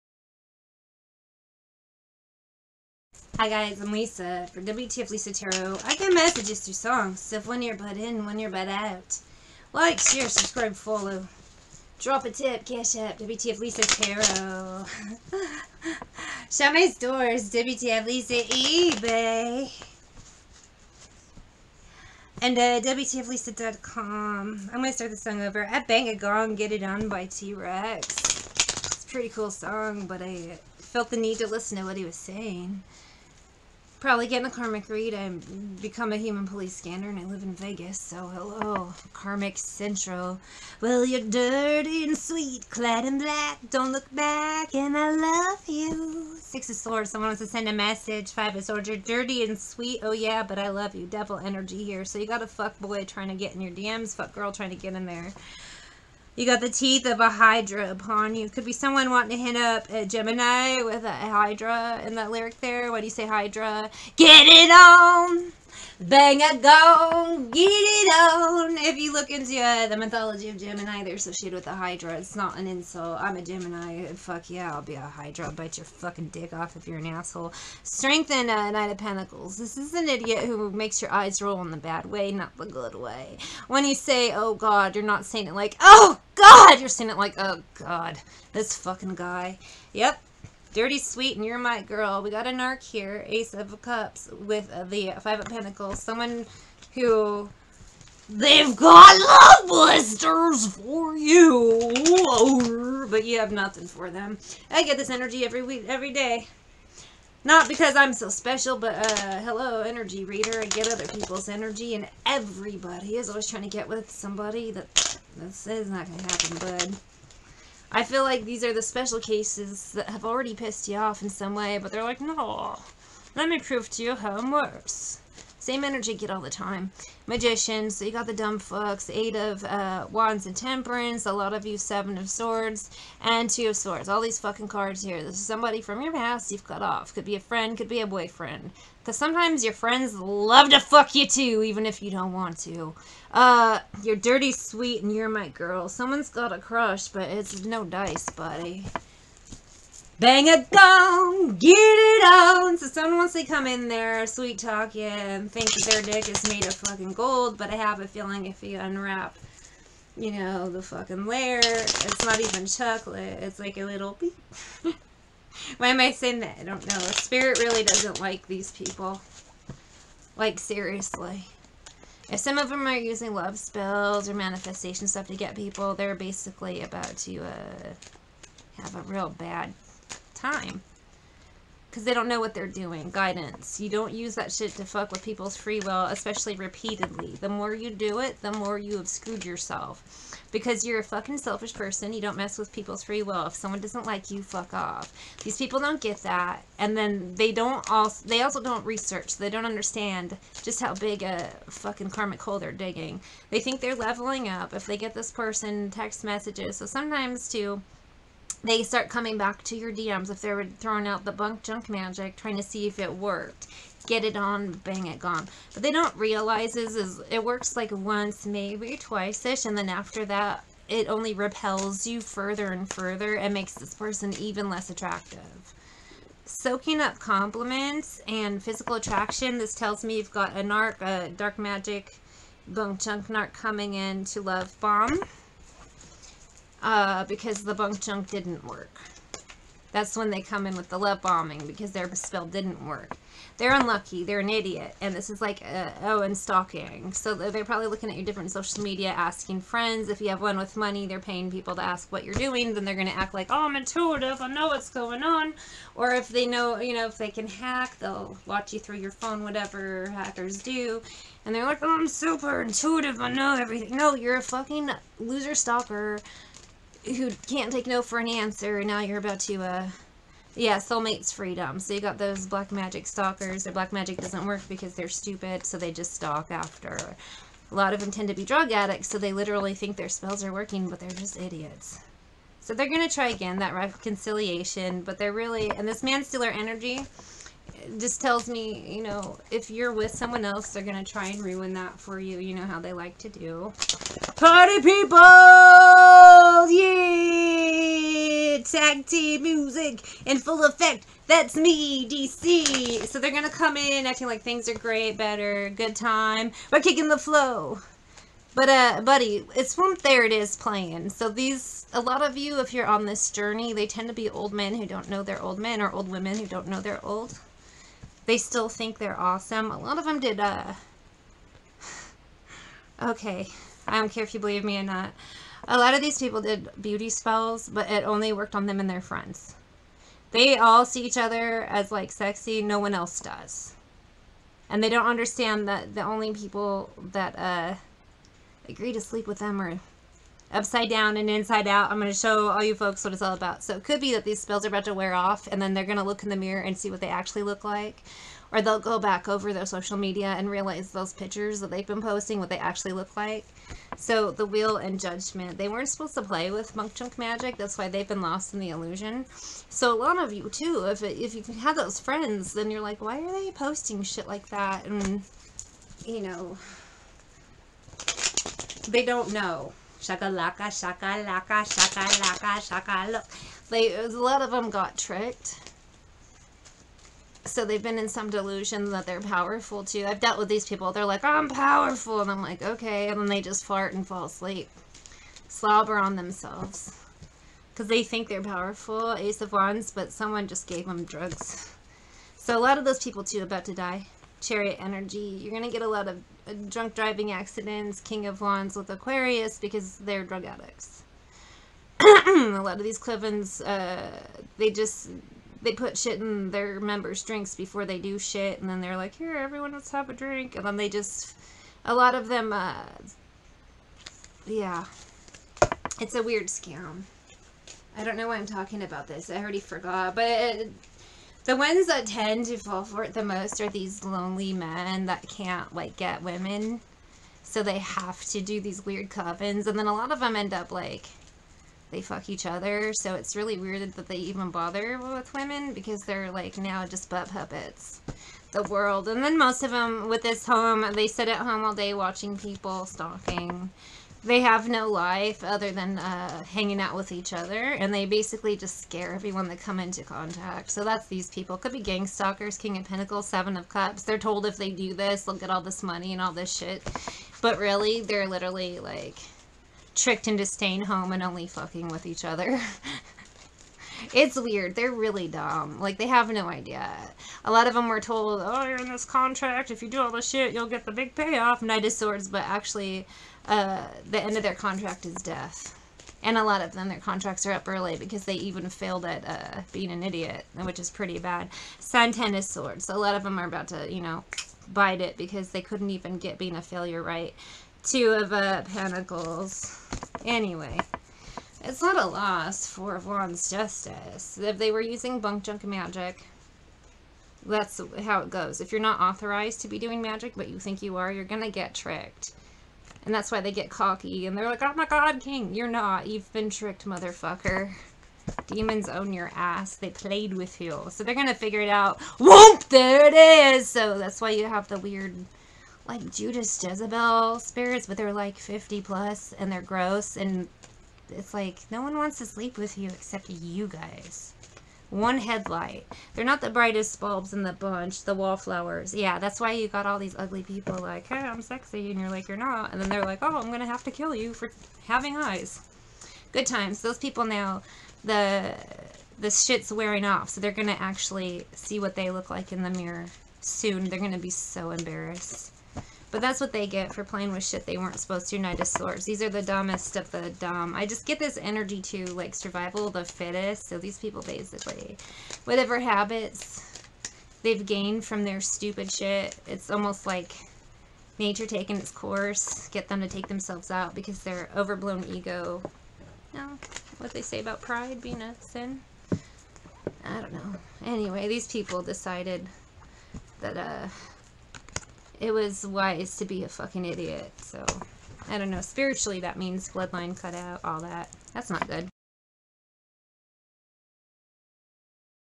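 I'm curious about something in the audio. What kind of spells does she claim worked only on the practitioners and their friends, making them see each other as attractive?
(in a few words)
beauty spells.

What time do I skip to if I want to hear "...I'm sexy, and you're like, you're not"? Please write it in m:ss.
8:51.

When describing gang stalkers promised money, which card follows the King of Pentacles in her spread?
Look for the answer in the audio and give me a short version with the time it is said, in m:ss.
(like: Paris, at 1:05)
Seven of Cups, at 7:33.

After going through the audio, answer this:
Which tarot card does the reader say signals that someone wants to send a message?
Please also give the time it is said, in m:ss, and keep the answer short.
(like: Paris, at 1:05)
Six of Swords, at 0:46.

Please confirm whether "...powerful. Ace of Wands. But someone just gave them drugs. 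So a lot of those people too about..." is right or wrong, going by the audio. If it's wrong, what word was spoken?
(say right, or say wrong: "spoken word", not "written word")
right.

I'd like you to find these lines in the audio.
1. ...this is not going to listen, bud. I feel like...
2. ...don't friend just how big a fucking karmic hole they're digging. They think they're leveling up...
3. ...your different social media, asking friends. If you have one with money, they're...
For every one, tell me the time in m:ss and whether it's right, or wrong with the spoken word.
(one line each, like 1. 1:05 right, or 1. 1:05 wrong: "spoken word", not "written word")
1. 1:55 wrong: "happen", not "listen"
2. 3:19 wrong: "understand", not "friend"
3. 4:08 right.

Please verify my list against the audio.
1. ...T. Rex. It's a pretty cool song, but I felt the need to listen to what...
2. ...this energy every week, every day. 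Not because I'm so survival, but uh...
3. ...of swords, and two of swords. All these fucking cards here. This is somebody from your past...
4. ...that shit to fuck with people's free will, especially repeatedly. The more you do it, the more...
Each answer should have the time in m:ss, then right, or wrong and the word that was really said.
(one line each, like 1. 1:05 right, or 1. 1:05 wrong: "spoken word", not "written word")
1. 0:27 right
2. 1:44 wrong: "special", not "survival"
3. 2:12 right
4. 3:04 right.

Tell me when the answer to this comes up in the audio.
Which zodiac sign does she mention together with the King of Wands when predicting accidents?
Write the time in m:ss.
6:38.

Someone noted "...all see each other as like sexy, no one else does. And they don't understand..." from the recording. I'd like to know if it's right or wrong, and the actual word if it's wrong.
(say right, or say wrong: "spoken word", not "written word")
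right.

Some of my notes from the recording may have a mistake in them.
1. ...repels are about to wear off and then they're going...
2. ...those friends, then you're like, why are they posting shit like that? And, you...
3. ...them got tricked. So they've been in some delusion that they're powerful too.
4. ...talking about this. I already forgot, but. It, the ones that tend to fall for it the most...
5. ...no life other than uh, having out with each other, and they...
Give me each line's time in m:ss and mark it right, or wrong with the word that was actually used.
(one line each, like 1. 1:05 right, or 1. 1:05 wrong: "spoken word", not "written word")
1. 5:44 wrong: "spells", not "repels"
2. 6:01 right
3. 6:14 right
4. 6:58 right
5. 7:24 wrong: "hanging", not "having".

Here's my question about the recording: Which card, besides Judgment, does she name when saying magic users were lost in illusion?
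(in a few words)
The Wheel.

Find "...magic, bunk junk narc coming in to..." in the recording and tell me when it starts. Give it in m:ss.
3:51.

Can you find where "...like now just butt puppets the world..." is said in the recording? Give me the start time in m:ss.
7:16.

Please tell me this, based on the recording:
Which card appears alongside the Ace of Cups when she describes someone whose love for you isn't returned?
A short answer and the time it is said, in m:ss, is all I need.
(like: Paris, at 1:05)
Five of Pentacles, at 1:35.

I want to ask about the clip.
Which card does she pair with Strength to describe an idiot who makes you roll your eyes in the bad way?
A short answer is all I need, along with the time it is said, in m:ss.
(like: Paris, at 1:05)
Knight of Pentacles, at 1:18.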